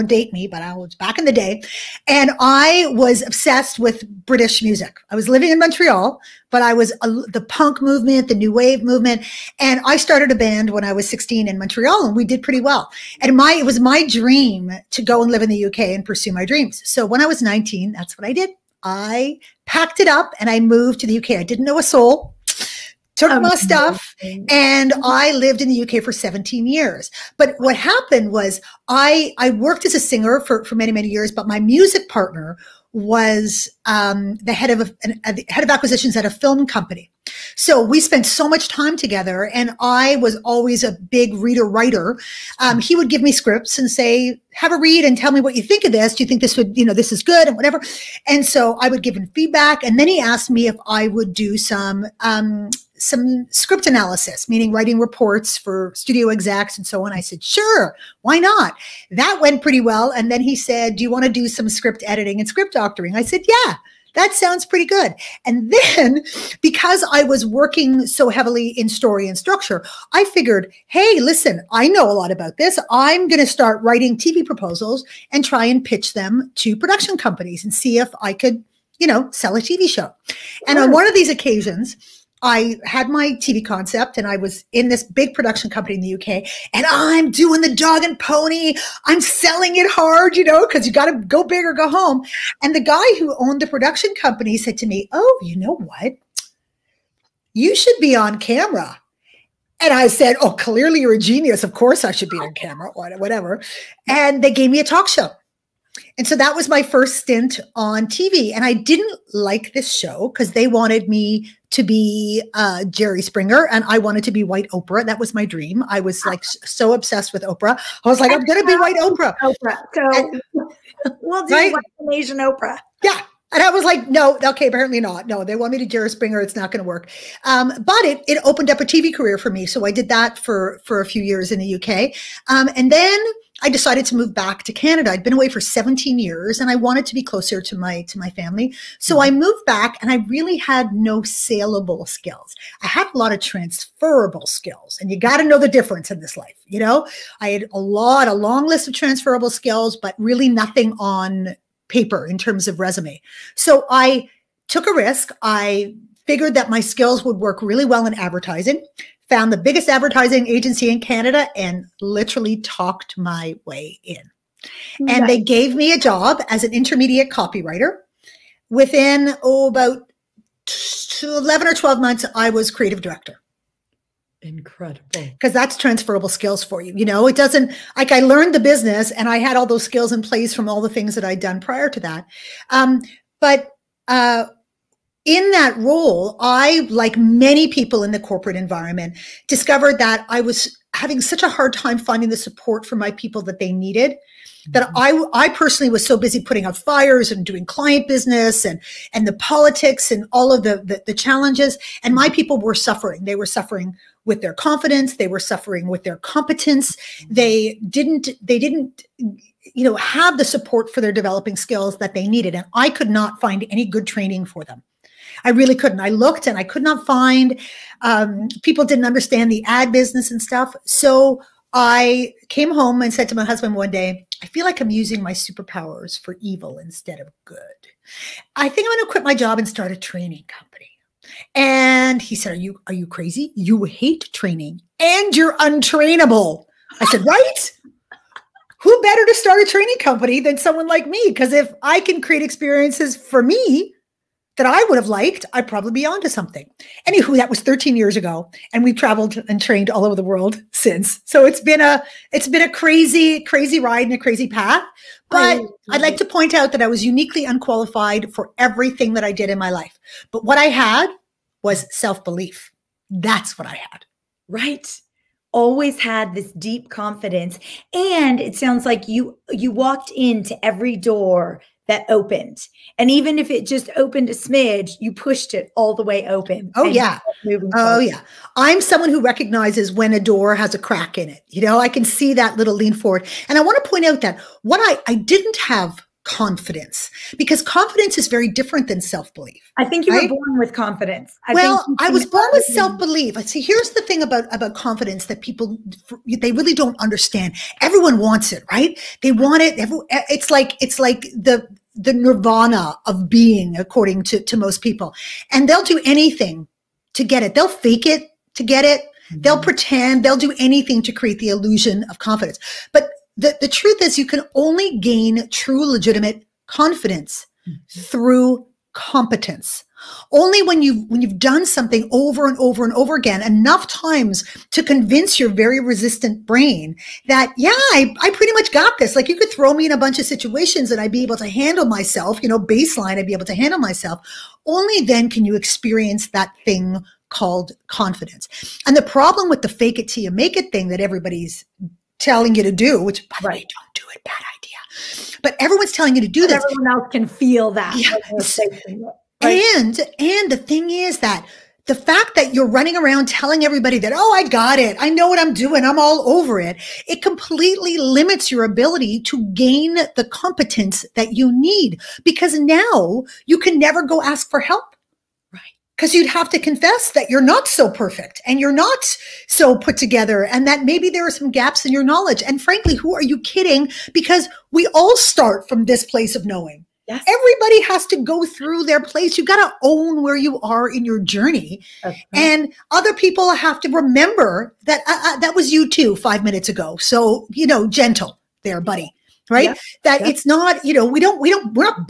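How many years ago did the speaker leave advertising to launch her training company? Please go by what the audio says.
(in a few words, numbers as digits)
13.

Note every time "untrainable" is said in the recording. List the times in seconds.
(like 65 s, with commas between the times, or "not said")
235 s.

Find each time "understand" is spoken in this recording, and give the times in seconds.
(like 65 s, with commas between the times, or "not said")
219 s, 297 s.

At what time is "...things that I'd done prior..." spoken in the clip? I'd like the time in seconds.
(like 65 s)
180 s.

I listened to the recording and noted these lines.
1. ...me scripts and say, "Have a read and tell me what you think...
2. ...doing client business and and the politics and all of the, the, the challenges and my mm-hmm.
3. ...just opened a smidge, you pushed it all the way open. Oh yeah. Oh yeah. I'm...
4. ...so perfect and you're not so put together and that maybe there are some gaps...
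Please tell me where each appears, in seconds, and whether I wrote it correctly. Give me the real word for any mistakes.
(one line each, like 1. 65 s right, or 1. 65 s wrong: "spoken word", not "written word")
1. 43 s right
2. 197 s right
3. 273 s right
4. 367 s right.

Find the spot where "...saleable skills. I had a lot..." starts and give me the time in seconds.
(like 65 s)
141 s.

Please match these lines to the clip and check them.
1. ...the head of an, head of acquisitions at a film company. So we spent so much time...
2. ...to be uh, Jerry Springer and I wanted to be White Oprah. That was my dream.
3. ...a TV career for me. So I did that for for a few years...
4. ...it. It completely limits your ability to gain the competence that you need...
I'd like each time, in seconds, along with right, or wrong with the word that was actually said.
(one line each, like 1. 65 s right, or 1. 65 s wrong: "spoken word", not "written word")
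1. 34 s right
2. 111 s right
3. 128 s right
4. 356 s right.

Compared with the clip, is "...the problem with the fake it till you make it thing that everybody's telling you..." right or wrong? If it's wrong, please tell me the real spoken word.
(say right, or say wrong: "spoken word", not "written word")
right.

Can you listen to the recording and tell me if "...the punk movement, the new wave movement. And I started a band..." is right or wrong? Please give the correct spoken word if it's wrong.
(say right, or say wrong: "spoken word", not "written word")
right.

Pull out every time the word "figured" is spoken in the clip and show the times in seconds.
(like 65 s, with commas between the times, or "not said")
70 s, 156 s.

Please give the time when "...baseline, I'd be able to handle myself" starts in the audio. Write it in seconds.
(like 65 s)
332 s.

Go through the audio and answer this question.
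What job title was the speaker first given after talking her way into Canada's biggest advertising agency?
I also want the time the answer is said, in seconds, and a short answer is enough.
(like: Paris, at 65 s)
intermediate copywriter, at 166 s.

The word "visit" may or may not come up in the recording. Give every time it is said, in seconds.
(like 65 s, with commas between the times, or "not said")
not said.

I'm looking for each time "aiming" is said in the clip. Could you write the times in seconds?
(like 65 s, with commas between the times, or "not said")
not said.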